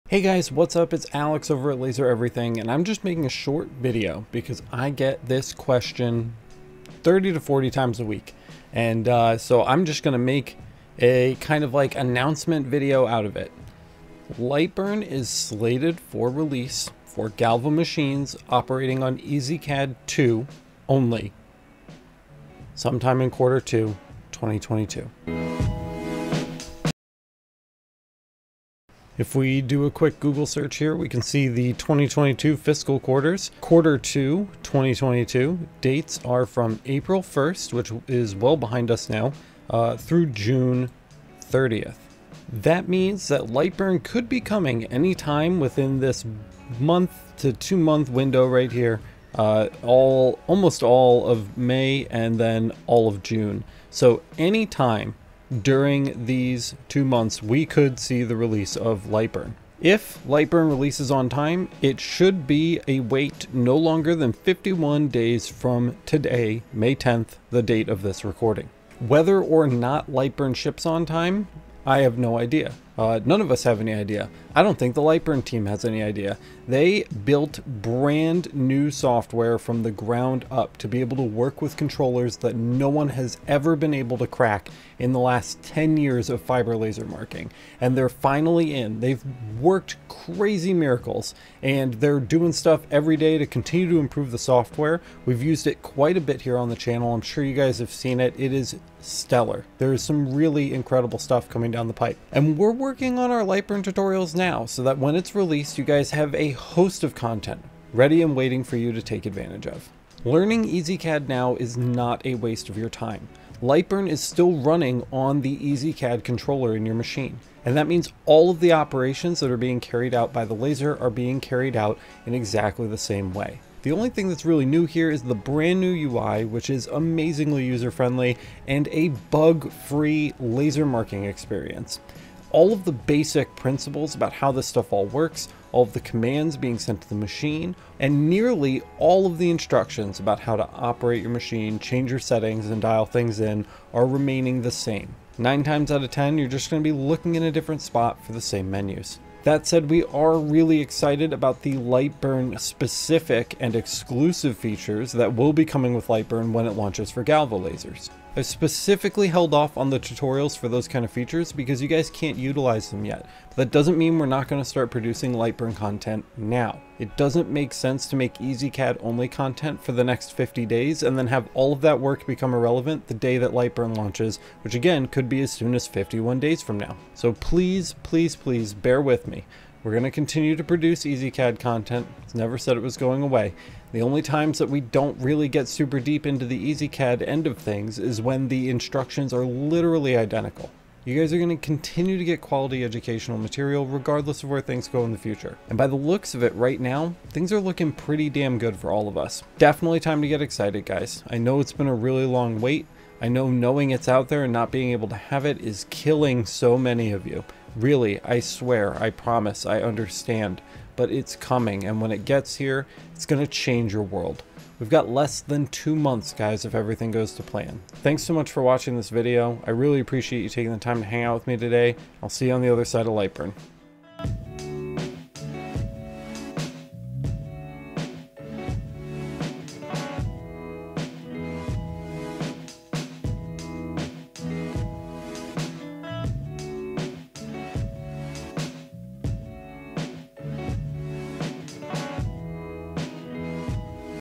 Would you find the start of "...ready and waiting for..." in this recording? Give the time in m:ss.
1:47.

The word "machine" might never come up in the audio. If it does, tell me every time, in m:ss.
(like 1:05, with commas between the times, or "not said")
0:17, 1:56, 2:17, 2:21.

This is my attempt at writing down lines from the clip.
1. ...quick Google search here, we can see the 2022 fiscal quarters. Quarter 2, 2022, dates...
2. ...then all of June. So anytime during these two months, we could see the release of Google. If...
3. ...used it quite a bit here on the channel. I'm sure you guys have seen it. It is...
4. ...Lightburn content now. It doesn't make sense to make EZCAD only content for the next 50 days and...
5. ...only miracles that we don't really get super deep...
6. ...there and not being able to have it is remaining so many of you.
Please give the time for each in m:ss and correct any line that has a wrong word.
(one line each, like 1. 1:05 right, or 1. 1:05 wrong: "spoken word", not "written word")
1. 0:29 right
2. 0:52 wrong: "Lightburn", not "Google"
3. 1:35 right
4. 2:45 right
5. 3:04 wrong: "times", not "miracles"
6. 3:24 wrong: "killing", not "remaining".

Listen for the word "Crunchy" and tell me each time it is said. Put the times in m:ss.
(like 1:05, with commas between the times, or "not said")
not said.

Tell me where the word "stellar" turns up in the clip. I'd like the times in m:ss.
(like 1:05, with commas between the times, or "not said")
1:38.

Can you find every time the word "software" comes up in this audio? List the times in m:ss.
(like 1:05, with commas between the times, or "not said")
1:18, 1:34.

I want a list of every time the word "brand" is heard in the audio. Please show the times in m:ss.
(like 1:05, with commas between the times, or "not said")
1:17, 2:05.